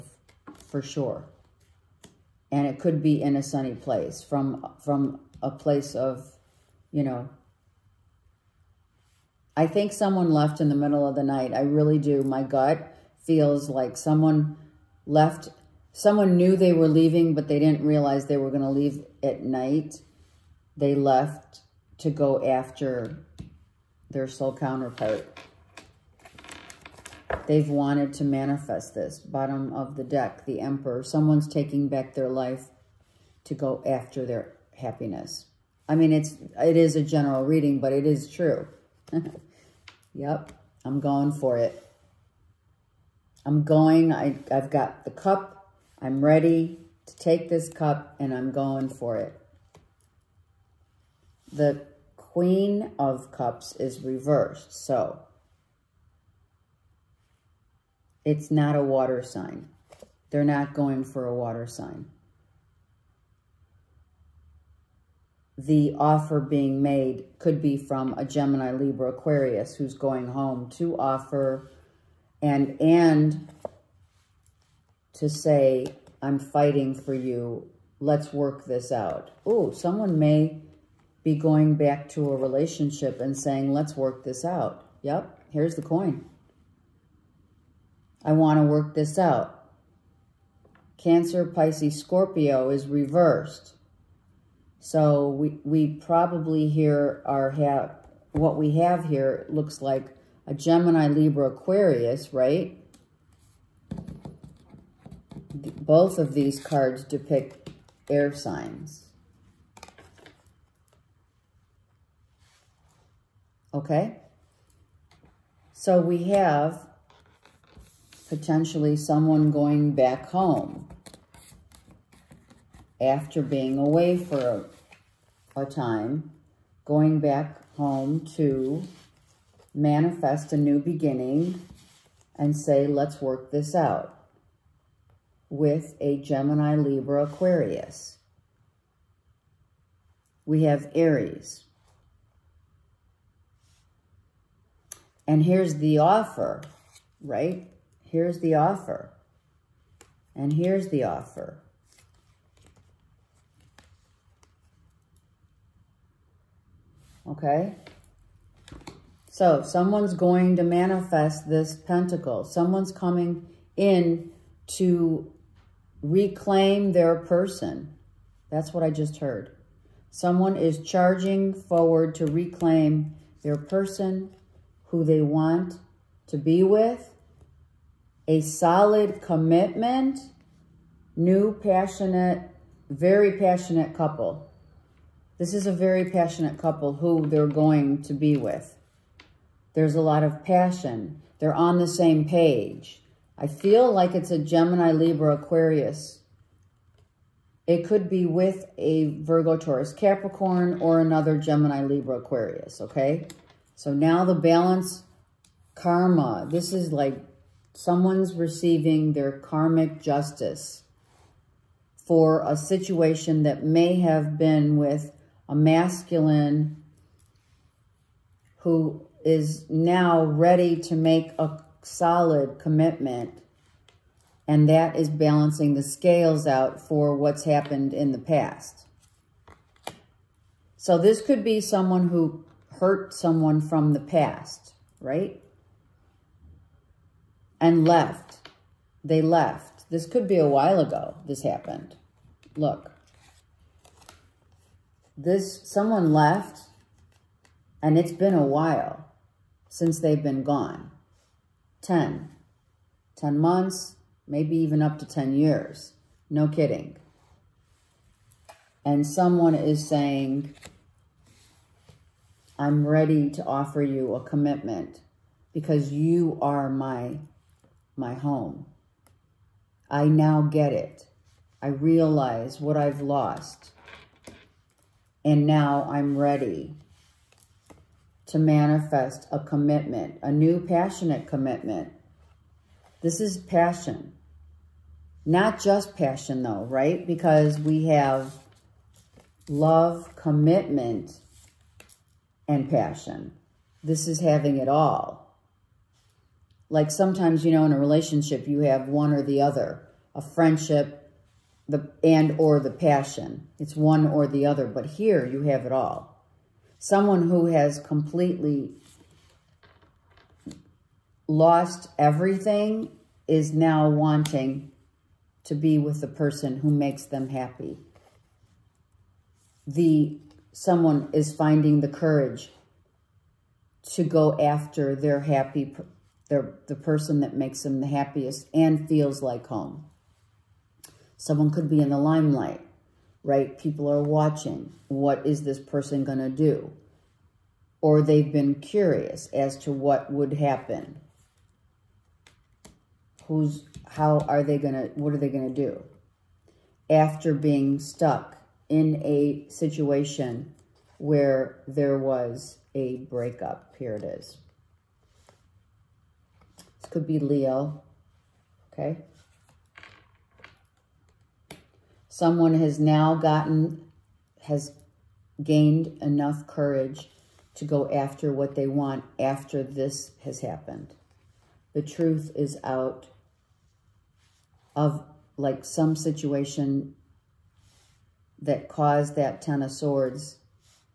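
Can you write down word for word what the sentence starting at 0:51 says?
The Queen of Cups is reversed, so it's not a water sign.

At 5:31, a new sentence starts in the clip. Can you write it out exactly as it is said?
Someone could be in the limelight, right?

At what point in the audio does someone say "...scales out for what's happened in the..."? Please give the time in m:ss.
3:45.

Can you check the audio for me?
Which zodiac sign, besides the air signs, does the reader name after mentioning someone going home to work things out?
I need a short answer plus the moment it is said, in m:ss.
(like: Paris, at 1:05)
Aries, at 2:20.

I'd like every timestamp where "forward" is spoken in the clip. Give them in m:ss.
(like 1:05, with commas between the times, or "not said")
2:51.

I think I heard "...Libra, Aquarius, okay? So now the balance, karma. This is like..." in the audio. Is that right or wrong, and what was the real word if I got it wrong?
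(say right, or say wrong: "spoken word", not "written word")
right.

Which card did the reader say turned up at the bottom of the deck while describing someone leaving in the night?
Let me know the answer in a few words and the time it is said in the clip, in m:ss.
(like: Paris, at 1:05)
The Emperor, at 0:30.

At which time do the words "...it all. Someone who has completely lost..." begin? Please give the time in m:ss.
5:05.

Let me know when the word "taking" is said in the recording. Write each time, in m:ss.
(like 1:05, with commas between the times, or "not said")
0:31.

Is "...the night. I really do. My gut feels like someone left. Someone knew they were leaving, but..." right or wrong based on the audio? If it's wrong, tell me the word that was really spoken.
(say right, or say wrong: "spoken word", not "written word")
right.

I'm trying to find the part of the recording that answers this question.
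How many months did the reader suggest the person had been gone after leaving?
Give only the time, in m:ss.
4:13.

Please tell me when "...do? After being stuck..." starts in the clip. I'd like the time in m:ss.
5:45.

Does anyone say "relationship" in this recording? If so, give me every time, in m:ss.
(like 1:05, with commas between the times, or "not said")
1:22, 4:57.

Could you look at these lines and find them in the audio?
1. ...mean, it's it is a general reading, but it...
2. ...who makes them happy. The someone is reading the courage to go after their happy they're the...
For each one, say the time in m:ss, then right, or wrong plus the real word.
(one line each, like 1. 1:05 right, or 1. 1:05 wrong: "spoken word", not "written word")
1. 0:35 right
2. 5:16 wrong: "finding", not "reading".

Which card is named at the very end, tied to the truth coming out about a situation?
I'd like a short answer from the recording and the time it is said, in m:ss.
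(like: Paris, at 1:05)
Ten of Swords, at 6:19.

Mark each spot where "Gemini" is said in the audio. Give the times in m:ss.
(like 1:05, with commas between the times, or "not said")
1:08, 1:40, 2:16, 3:14, 3:21.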